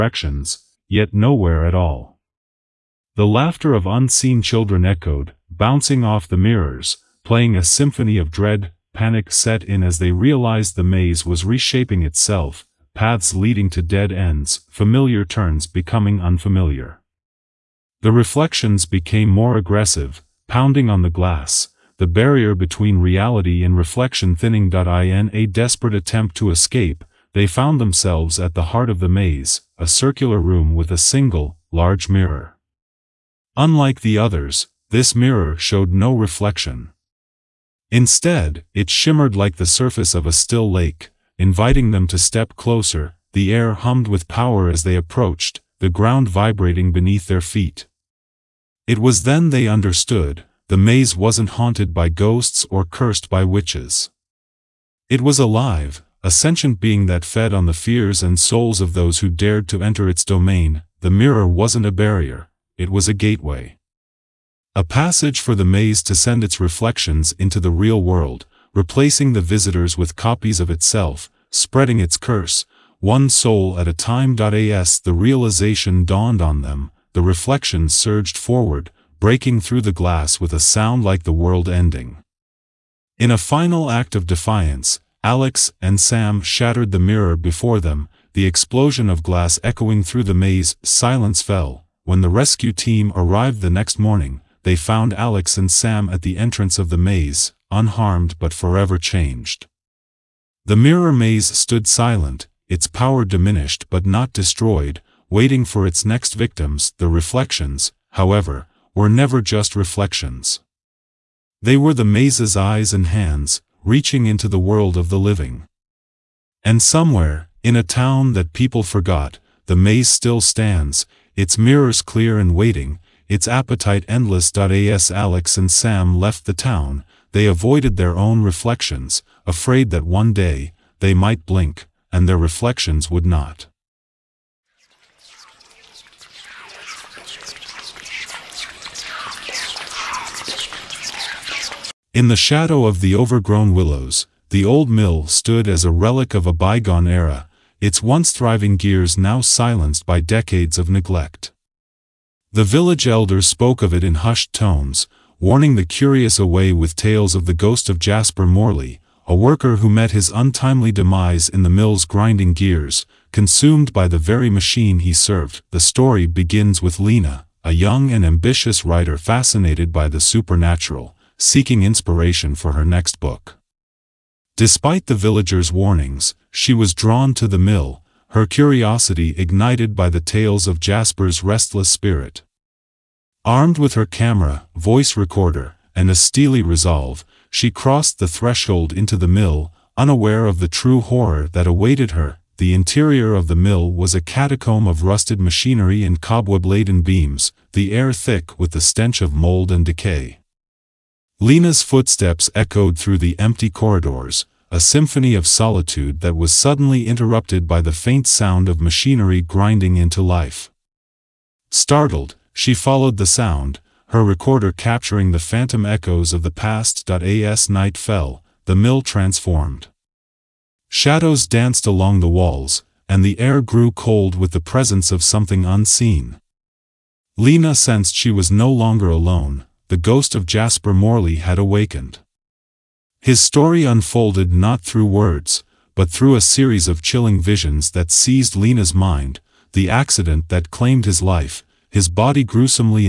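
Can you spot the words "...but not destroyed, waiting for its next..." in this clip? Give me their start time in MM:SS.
01:43.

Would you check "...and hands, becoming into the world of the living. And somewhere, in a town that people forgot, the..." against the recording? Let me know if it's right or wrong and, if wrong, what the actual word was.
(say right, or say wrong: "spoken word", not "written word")
wrong: "reaching", not "becoming".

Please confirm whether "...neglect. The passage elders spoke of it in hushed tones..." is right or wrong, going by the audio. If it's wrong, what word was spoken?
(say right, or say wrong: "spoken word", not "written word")
wrong: "village", not "passage".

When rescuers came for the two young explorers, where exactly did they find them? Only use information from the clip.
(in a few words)
At the entrance of the maze.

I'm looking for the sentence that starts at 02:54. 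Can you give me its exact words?
Despite the villagers' warnings, she was drawn to the mill, her curiosity ignited by the tales of Jasper's restless spirit.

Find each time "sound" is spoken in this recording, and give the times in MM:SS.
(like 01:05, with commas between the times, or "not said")
01:20, 03:28, 03:33.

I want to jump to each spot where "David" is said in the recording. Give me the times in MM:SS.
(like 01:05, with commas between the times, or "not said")
not said.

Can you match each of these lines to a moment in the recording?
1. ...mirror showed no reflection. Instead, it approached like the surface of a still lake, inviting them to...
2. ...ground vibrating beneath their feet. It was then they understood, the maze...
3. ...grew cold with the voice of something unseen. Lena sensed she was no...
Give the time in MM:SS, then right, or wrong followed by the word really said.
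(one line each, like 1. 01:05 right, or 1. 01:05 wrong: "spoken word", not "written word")
1. 00:35 wrong: "shimmered", not "approached"
2. 00:45 right
3. 03:43 wrong: "presence", not "voice".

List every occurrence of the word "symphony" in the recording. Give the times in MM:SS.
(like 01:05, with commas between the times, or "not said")
00:07, 03:24.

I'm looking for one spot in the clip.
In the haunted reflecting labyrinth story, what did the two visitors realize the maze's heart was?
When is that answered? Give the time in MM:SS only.
01:03.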